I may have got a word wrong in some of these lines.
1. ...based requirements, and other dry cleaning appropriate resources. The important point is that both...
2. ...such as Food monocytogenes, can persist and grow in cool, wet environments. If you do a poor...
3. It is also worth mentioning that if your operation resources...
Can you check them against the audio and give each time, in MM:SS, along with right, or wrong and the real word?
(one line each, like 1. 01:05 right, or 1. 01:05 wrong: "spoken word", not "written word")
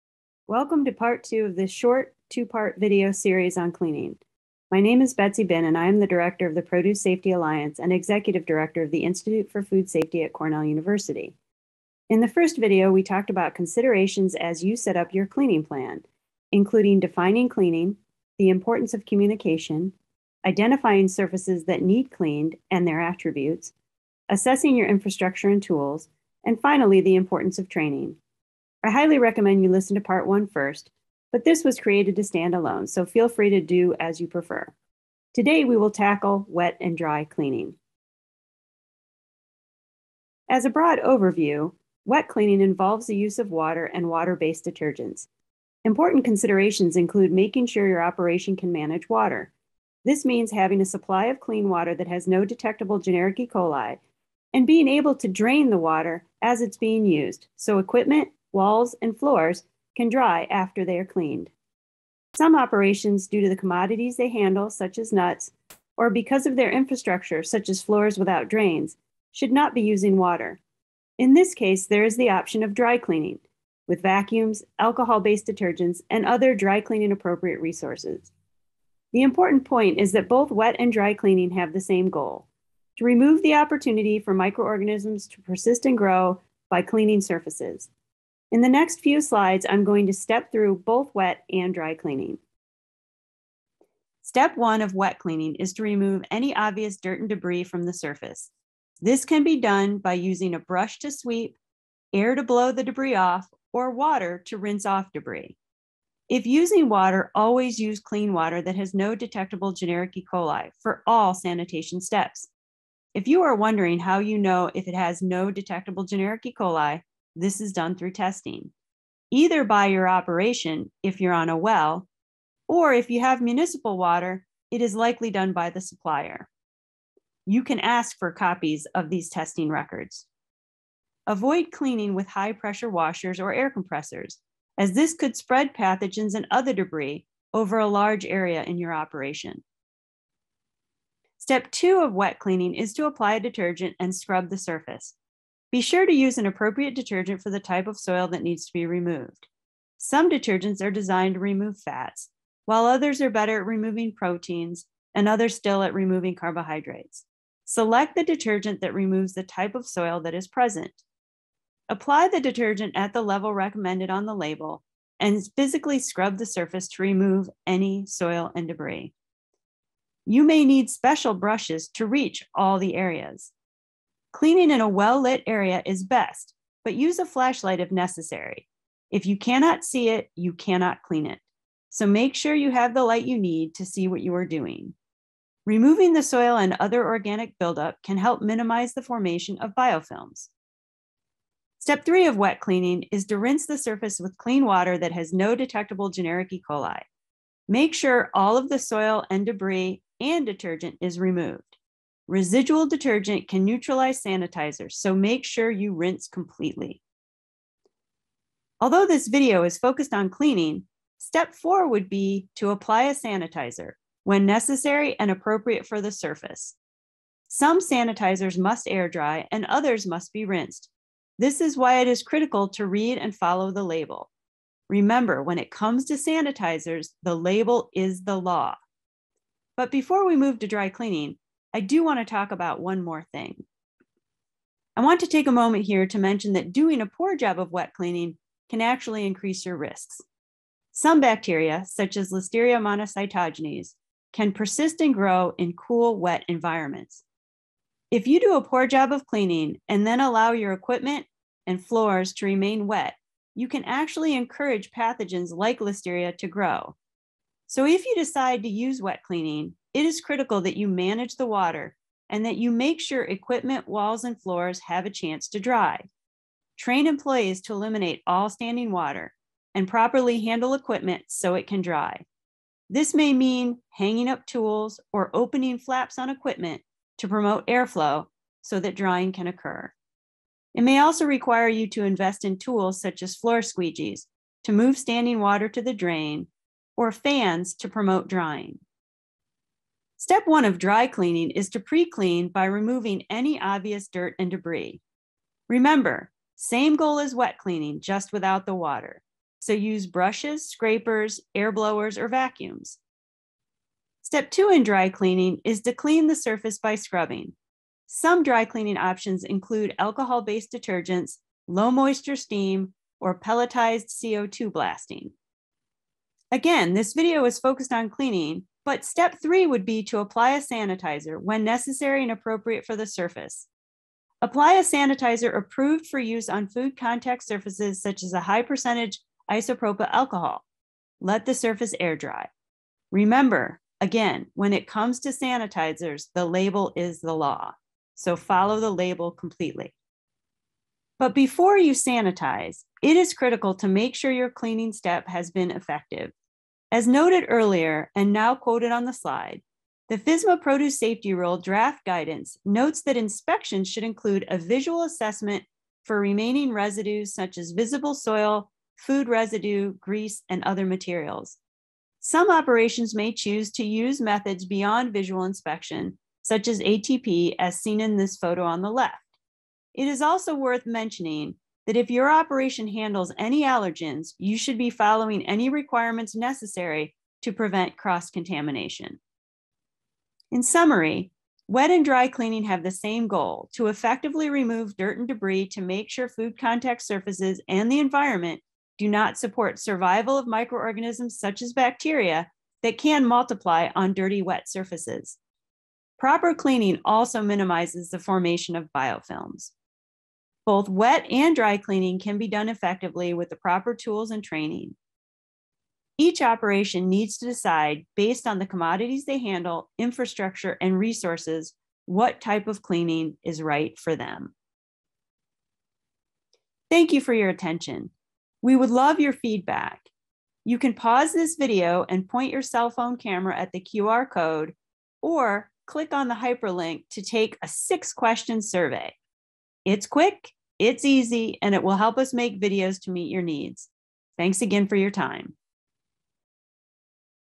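1. 01:15 wrong: "detergents", not "requirements"
2. 04:01 wrong: "Listeria", not "Food"
3. 06:09 wrong: "handles", not "resources".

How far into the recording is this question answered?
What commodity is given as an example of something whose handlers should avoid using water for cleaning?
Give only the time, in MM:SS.
01:05.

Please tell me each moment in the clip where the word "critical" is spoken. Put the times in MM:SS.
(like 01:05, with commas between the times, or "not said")
03:42, 04:20, 05:43.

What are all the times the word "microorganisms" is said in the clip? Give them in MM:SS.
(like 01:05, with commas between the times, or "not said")
01:24, 06:30.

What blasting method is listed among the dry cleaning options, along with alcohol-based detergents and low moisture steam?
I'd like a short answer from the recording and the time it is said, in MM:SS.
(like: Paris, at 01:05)
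pelletized CO2 blasting, at 05:13.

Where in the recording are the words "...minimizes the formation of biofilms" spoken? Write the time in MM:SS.
06:37.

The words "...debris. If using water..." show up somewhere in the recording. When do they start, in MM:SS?
01:45.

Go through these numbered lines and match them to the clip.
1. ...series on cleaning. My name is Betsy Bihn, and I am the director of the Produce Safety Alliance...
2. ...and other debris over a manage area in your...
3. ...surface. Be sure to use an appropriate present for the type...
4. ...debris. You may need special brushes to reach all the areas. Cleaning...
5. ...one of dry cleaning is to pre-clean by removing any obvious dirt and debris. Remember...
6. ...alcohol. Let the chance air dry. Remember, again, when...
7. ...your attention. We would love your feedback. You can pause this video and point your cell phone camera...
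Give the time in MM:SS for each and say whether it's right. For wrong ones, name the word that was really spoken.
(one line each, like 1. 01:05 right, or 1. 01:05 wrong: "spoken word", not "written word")
1. 00:03 right
2. 02:16 wrong: "large", not "manage"
3. 02:24 wrong: "detergent", not "present"
4. 02:48 right
5. 04:50 right
6. 05:30 wrong: "surface", not "chance"
7. 06:57 right.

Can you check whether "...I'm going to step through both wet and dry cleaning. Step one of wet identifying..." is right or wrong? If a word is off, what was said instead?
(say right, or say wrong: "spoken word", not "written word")
wrong: "cleaning", not "identifying".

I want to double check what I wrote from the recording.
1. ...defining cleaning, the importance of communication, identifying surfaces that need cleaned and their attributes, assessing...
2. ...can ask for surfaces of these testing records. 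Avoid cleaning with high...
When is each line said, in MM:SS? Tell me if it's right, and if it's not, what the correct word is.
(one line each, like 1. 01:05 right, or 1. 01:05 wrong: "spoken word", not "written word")
1. 00:16 right
2. 02:07 wrong: "copies", not "surfaces".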